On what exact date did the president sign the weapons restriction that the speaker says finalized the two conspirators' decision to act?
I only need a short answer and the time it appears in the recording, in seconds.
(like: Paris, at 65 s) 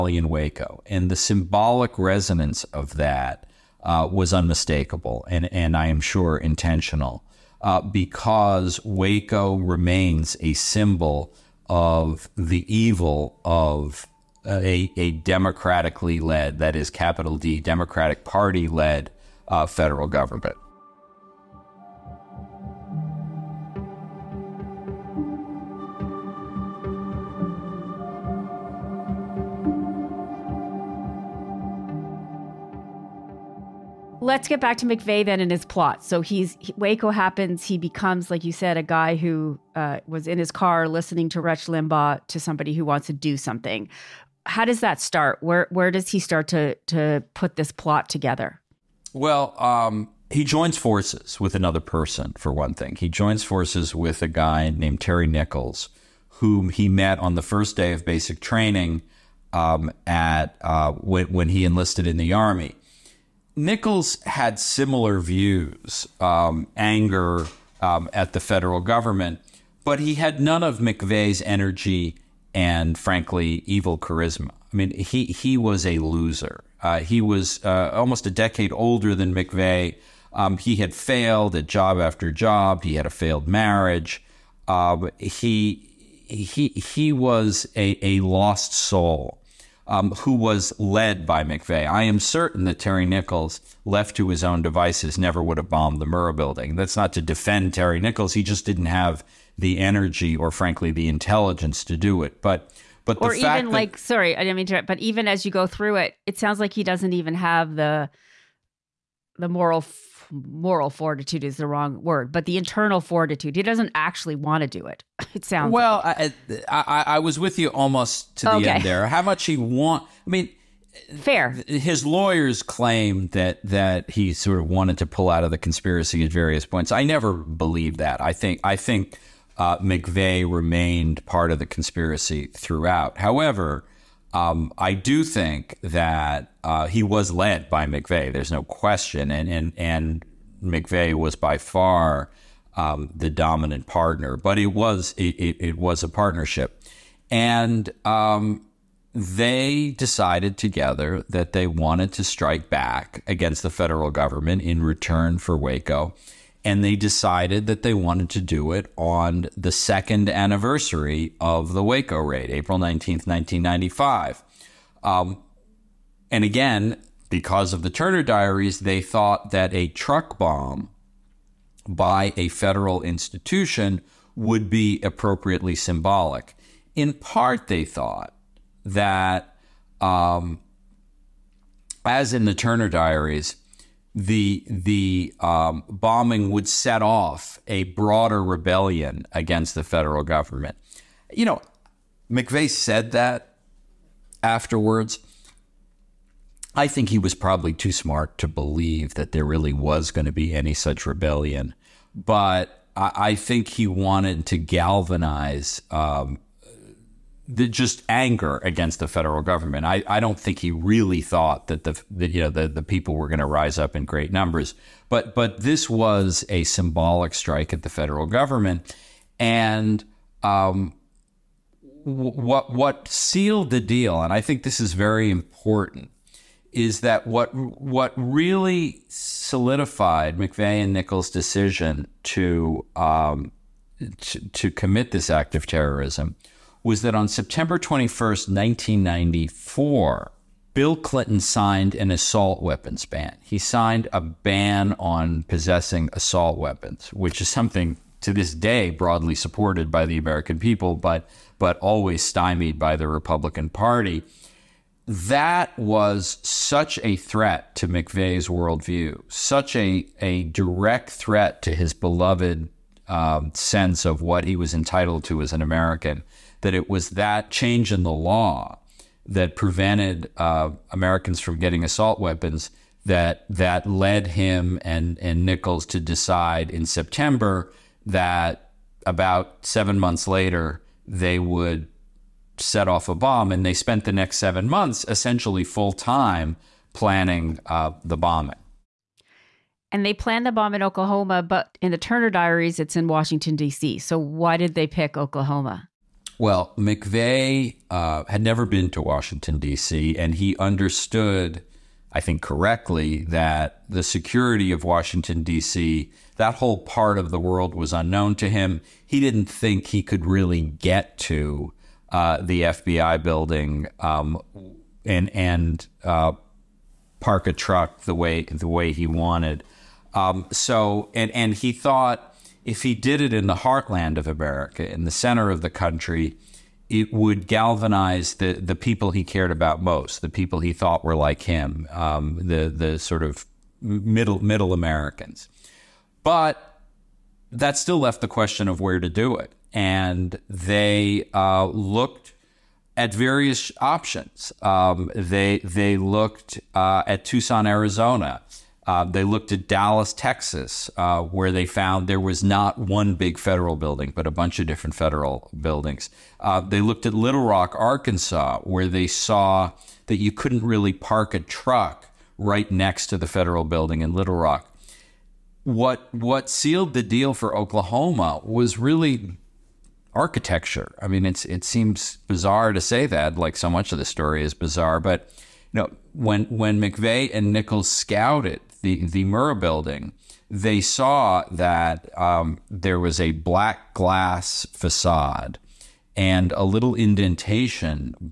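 September 21, 1994, at 237 s.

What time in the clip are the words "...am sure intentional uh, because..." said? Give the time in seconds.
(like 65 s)
5 s.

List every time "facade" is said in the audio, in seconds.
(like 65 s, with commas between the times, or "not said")
384 s.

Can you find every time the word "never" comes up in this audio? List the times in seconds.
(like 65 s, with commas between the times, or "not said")
95 s, 127 s, 298 s.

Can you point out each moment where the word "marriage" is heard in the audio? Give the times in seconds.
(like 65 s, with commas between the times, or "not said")
83 s.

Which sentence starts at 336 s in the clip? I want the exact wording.
But that still left the question of where to do it.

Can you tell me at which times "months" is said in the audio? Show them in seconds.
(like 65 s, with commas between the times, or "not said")
279 s, 284 s.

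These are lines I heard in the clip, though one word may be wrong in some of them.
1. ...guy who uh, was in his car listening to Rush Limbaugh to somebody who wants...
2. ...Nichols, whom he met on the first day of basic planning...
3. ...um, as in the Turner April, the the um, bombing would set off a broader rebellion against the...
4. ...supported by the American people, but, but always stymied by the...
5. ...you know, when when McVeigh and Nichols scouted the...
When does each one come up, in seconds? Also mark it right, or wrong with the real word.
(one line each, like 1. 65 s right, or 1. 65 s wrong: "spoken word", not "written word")
1. 38 s right
2. 55 s wrong: "training", not "planning"
3. 180 s wrong: "Diaries", not "April"
4. 249 s right
5. 375 s right.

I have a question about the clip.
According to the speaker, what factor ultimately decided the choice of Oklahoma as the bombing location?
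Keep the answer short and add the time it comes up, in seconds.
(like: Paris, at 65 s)
Architecture, at 370 s.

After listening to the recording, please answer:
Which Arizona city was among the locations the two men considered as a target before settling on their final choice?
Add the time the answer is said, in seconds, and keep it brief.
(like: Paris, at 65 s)
Tucson, at 347 s.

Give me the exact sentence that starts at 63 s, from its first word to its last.
Nichols had similar views, um, anger um, at the federal government, but he had none of McVeigh's energy and, frankly, evil charisma.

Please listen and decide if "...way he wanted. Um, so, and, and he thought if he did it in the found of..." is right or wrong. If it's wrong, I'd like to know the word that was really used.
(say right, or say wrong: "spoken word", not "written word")
wrong: "heartland", not "found".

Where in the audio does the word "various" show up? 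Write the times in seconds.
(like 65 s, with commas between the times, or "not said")
126 s, 343 s.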